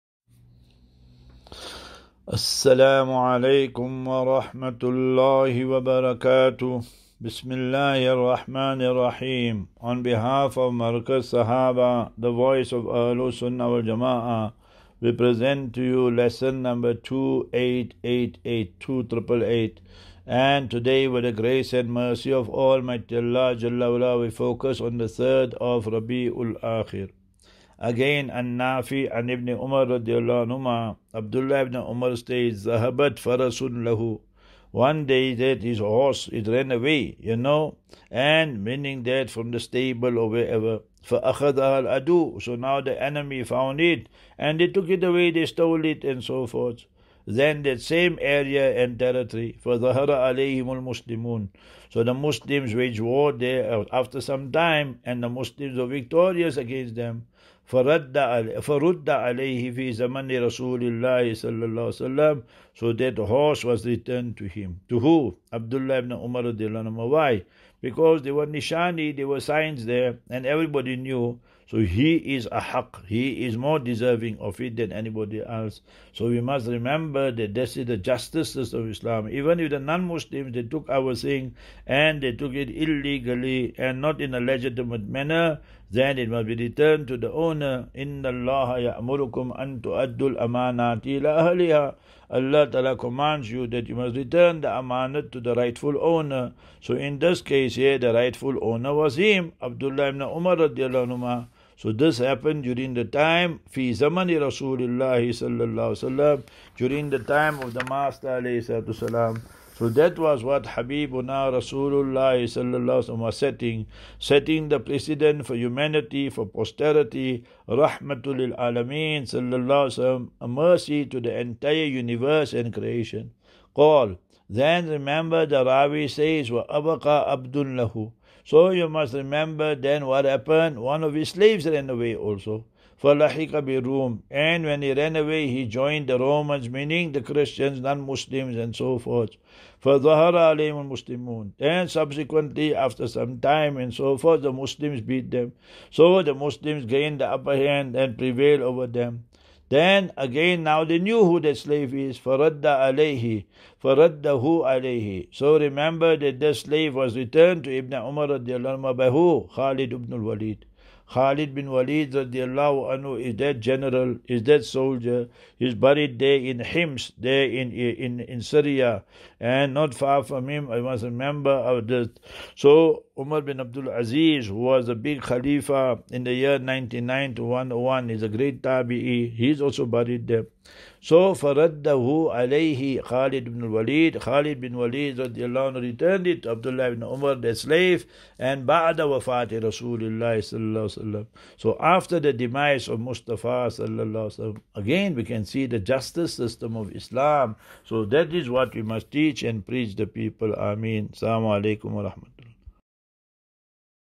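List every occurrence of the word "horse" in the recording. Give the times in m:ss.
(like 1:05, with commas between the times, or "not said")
0:35, 1:03.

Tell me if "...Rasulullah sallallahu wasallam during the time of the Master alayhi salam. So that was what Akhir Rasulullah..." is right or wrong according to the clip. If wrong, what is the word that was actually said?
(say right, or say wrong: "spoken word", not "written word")
wrong: "Habibuna", not "Akhir".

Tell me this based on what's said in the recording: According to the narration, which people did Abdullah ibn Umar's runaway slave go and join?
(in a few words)
The Romans.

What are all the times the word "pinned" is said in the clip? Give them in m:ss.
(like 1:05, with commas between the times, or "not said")
not said.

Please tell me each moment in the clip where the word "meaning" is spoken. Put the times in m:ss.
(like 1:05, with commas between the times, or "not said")
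0:38, 2:16.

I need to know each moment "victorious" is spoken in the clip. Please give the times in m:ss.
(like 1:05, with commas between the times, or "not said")
0:55.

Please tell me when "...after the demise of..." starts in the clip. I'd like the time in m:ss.
3:11.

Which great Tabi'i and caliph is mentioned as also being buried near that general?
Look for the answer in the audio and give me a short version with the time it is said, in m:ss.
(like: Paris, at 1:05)
Umar bin Abdul Aziz, at 2:53.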